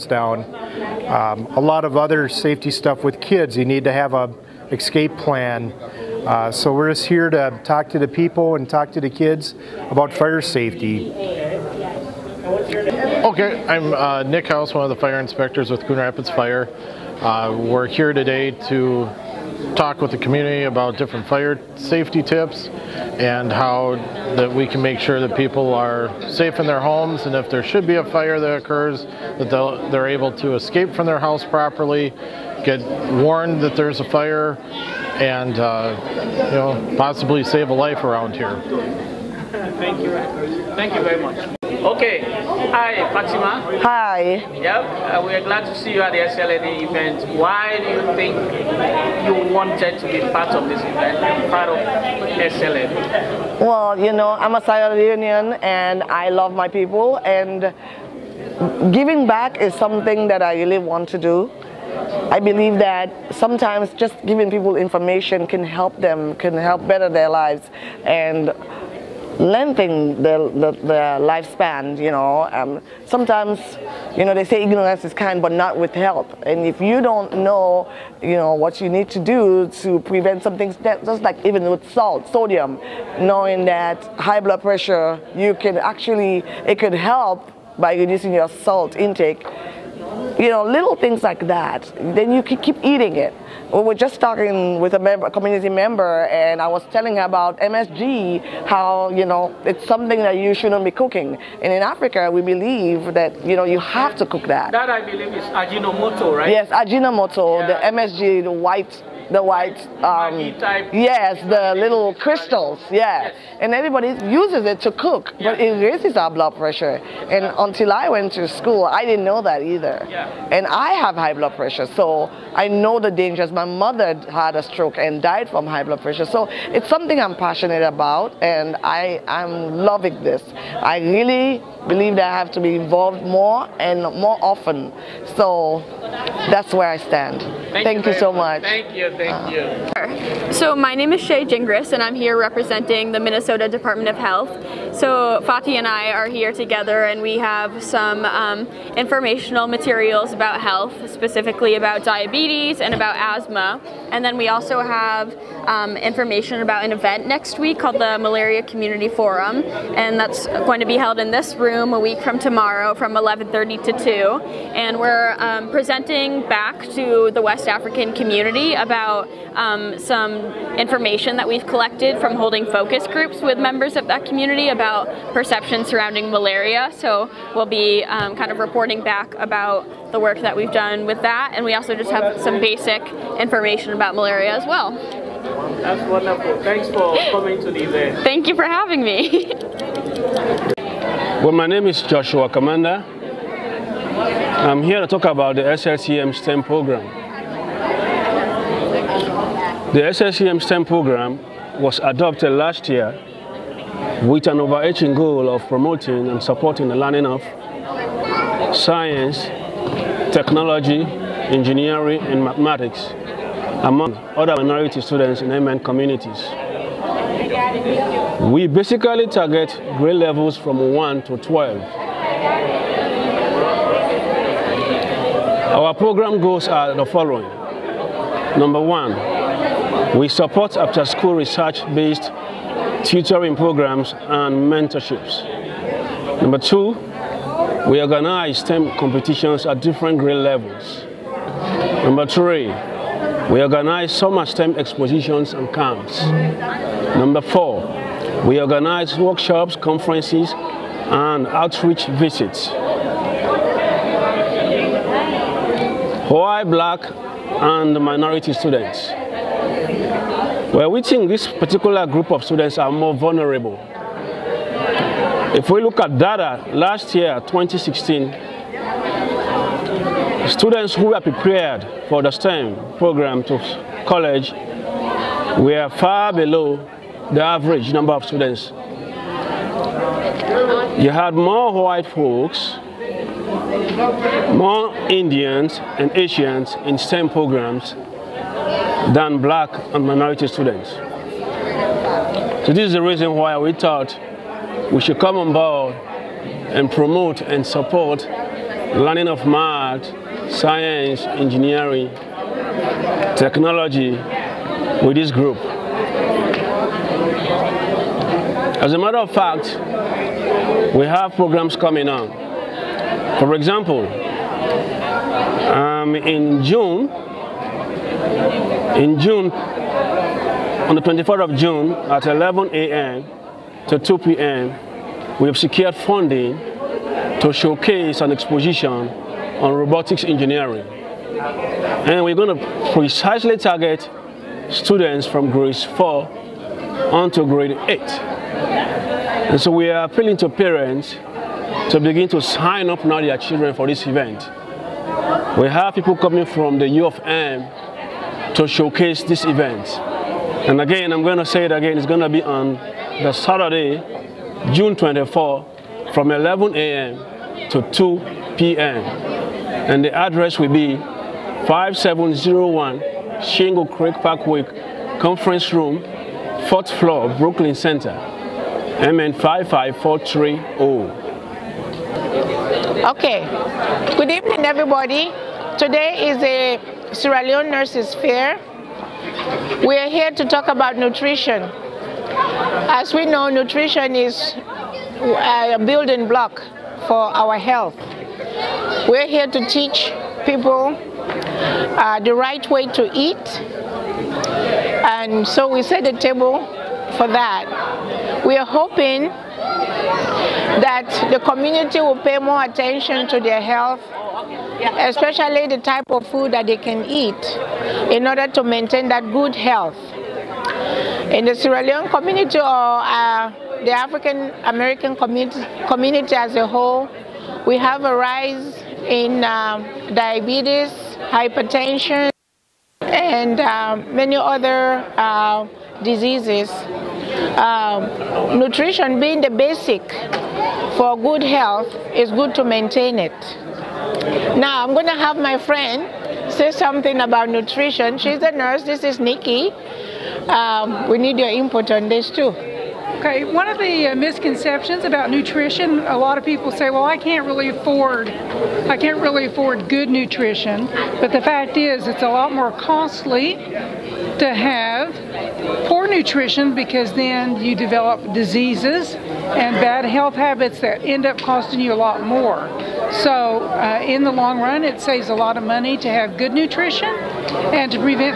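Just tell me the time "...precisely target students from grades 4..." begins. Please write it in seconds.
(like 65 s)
332 s.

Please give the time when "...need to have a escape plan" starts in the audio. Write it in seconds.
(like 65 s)
3 s.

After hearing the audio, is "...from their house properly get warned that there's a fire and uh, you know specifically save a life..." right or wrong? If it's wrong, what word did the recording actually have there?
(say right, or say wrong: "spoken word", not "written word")
wrong: "possibly", not "specifically".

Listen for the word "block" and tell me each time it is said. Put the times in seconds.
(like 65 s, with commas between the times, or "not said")
386 s.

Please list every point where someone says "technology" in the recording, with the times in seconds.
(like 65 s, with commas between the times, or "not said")
210 s, 303 s.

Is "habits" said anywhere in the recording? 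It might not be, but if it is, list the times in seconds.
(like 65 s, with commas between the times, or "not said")
460 s.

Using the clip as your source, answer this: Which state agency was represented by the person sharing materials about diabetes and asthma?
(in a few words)
Minnesota Department of Health.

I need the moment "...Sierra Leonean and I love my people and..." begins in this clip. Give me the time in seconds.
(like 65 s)
54 s.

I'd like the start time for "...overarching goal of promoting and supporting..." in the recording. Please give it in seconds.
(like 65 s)
204 s.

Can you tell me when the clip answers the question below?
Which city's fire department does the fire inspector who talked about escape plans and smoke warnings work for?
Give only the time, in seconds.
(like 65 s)
15 s.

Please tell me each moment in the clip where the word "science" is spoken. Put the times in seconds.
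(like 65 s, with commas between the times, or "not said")
208 s, 300 s.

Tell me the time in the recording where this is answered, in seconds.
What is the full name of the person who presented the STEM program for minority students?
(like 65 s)
192 s.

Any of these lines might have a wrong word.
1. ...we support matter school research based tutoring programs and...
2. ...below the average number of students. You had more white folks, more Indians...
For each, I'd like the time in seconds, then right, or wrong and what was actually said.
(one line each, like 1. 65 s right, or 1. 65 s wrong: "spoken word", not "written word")
1. 230 s wrong: "after", not "matter"
2. 276 s right.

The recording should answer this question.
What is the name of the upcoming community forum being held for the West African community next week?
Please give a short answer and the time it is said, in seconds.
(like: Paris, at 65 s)
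Malaria Community Forum, at 158 s.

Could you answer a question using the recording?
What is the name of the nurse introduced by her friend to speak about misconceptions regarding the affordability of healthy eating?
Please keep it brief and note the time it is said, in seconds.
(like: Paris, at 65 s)
Nikki, at 439 s.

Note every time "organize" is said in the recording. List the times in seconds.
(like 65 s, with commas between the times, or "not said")
238 s, 243 s, 248 s.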